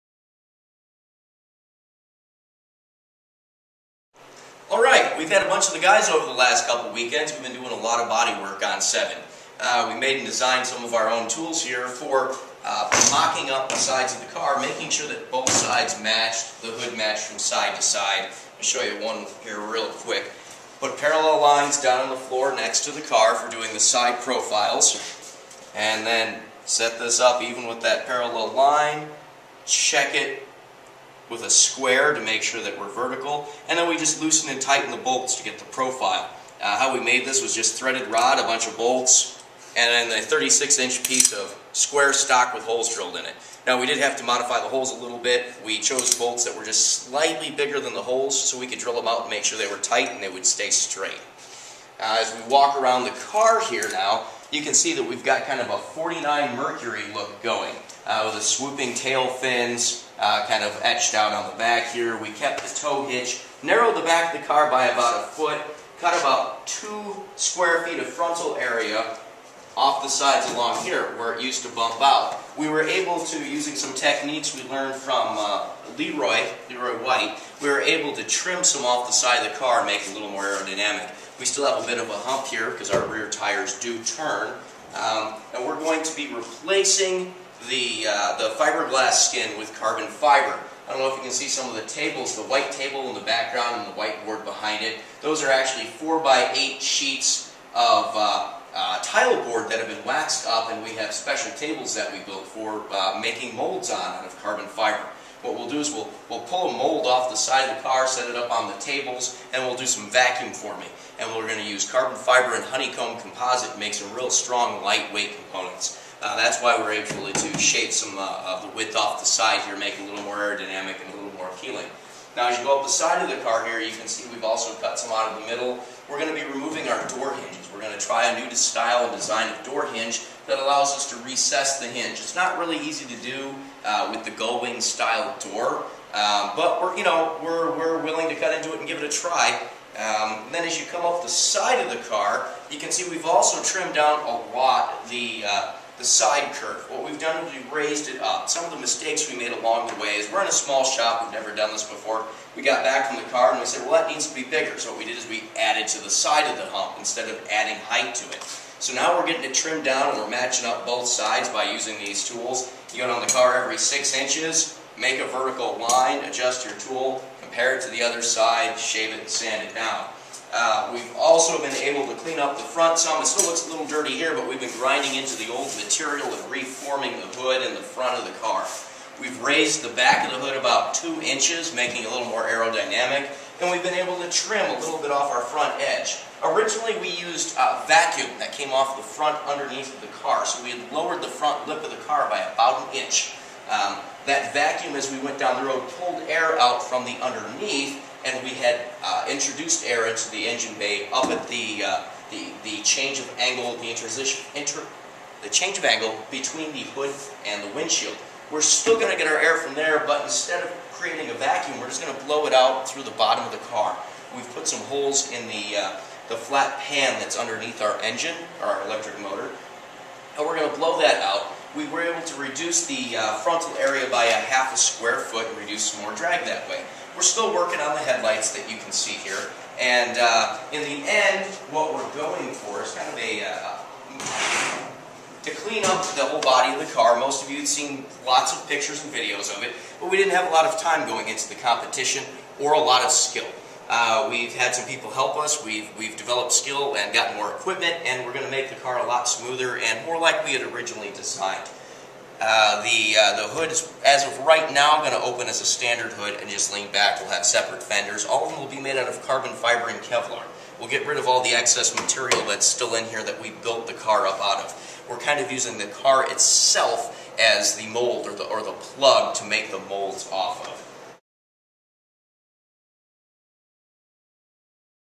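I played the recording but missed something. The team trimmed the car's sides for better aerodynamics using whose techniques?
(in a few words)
Leroy White.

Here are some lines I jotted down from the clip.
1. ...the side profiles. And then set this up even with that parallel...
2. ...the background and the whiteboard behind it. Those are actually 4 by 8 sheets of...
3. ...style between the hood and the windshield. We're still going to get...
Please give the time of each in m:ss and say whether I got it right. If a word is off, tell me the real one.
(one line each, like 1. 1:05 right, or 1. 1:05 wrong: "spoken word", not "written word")
1. 0:23 right
2. 1:33 right
3. 3:25 wrong: "angle", not "style".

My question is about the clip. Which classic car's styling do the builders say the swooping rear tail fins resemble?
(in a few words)
49 Mercury.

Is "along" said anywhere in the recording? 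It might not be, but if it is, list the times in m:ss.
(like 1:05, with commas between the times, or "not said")
1:10, 2:29.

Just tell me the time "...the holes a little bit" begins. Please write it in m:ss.
0:44.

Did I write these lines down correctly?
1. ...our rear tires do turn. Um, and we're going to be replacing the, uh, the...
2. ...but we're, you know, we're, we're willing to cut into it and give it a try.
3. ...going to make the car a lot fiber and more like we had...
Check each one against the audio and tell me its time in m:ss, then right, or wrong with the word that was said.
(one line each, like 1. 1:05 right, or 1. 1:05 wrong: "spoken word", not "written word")
1. 1:22 right
2. 2:16 right
3. 4:08 wrong: "smoother", not "fiber".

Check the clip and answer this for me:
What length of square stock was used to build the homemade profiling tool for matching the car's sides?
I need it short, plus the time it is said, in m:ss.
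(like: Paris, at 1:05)
36 inch, at 0:40.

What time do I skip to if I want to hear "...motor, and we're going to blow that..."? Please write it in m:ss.
3:39.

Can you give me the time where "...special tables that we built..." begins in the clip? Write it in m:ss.
1:41.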